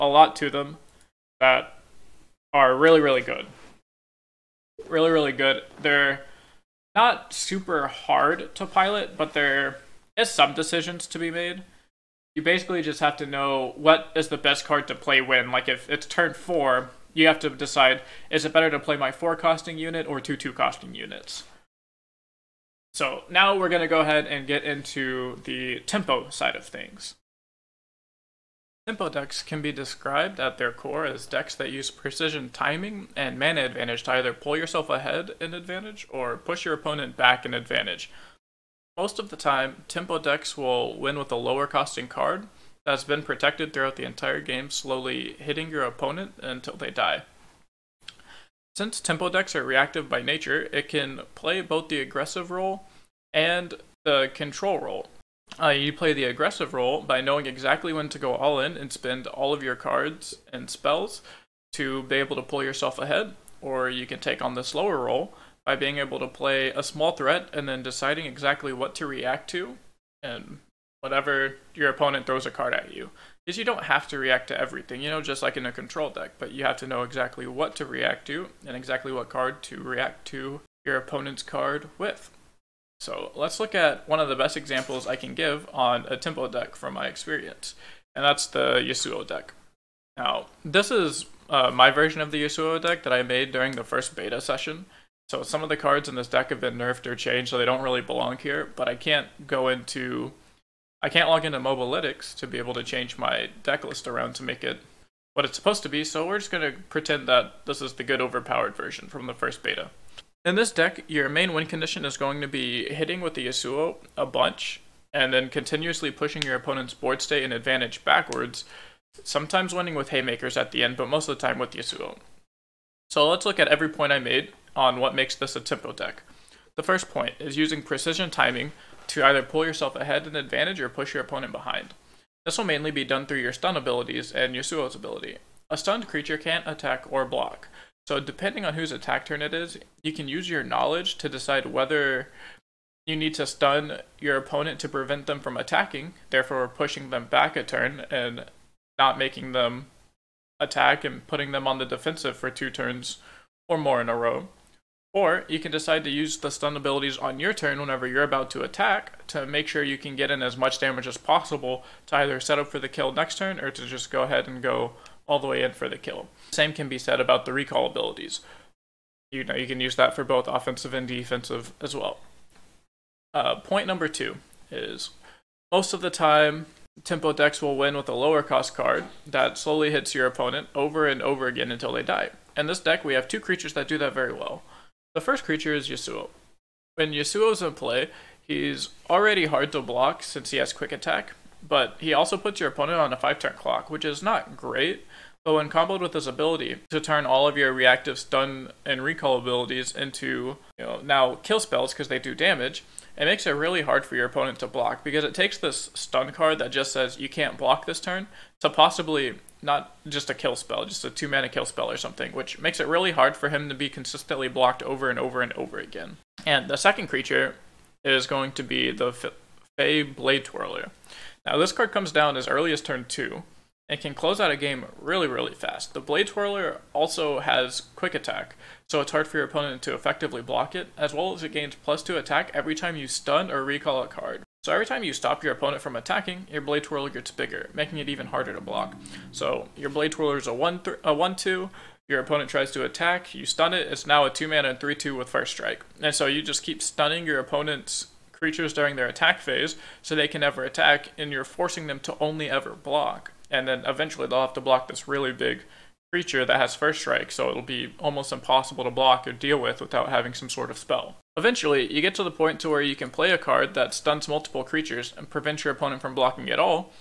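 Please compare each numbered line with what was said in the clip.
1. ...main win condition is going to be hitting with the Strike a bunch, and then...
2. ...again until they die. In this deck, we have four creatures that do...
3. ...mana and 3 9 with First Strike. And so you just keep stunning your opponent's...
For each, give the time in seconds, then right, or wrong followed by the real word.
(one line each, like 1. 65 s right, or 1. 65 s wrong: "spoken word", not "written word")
1. 111 s wrong: "Yasuo", not "Strike"
2. 181 s wrong: "two", not "four"
3. 244 s wrong: "2", not "9".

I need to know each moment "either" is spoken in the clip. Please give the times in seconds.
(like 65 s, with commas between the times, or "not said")
34 s, 129 s, 162 s.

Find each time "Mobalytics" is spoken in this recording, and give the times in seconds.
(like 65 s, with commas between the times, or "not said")
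101 s.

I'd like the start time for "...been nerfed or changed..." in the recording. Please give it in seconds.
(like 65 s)
96 s.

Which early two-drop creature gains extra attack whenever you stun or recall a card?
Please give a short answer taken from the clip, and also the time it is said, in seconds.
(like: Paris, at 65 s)
Fey Blade Twirler, at 219 s.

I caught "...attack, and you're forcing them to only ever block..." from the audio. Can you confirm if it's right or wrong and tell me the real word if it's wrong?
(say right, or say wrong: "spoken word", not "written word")
right.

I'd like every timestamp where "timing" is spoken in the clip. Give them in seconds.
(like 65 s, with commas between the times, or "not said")
32 s, 128 s.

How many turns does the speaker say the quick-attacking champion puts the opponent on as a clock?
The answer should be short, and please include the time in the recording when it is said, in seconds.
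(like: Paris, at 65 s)
5, at 193 s.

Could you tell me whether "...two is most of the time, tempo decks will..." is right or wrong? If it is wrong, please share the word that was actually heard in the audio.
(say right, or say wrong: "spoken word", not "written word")
right.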